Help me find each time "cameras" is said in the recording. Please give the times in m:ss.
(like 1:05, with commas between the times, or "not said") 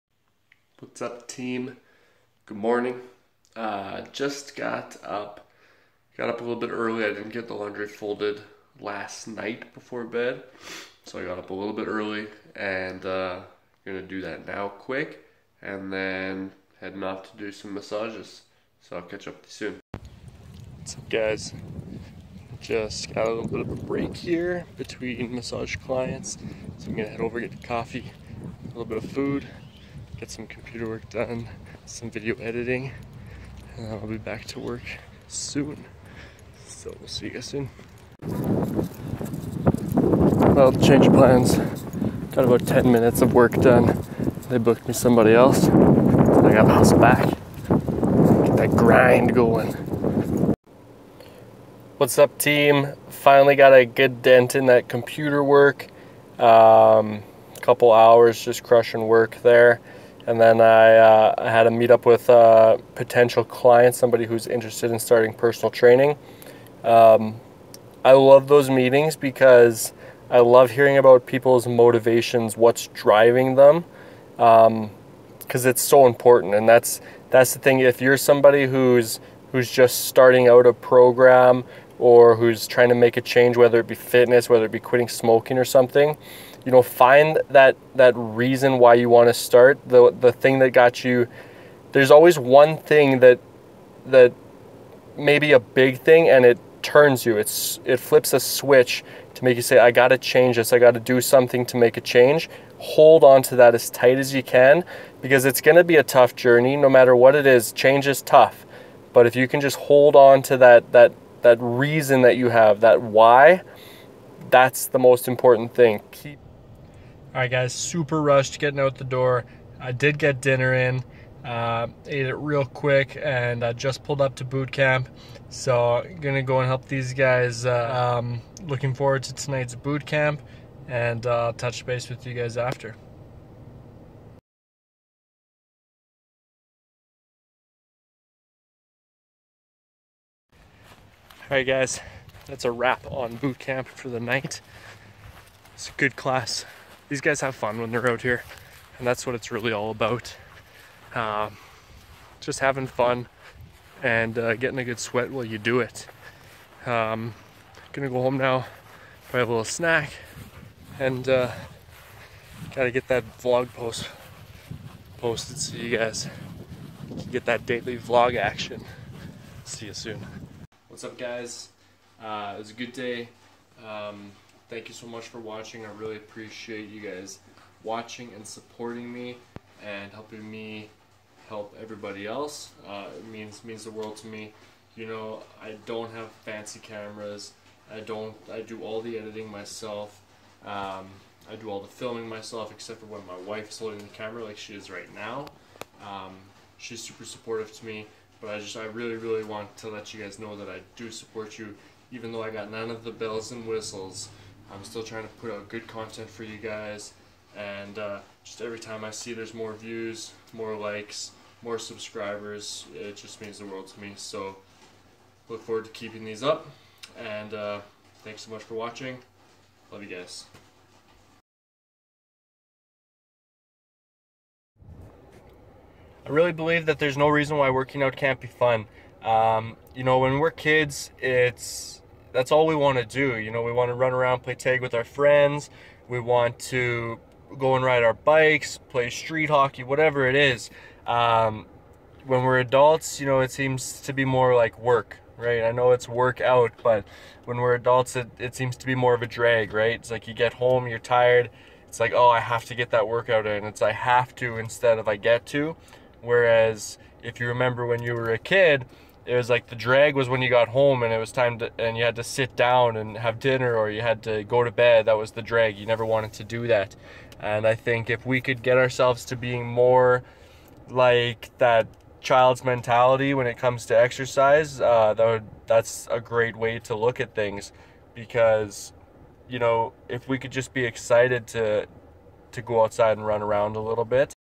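3:06, 3:14.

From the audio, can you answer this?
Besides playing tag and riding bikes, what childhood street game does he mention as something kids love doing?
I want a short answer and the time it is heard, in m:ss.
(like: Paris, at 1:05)
Street hockey, at 3:59.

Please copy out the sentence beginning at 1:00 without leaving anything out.
And then I, uh, I had a meetup with a uh, potential client, somebody who's interested in starting personal training.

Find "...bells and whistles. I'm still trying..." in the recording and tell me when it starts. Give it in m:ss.
3:23.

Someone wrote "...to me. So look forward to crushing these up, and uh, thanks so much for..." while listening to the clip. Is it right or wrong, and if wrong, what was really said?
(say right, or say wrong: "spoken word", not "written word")
wrong: "keeping", not "crushing".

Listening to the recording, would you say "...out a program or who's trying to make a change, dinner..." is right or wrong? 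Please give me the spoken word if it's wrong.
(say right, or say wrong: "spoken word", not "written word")
wrong: "whether", not "dinner".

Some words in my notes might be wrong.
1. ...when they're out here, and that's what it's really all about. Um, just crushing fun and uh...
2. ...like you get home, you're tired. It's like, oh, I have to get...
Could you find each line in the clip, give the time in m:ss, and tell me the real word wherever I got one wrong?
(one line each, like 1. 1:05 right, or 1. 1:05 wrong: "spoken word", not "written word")
1. 2:27 wrong: "having", not "crushing"
2. 4:10 right.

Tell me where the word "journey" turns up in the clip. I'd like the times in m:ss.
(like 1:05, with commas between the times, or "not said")
1:46.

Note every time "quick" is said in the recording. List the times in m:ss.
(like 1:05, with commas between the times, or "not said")
0:14, 2:02.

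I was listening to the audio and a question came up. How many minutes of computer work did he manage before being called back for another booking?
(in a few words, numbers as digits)
10.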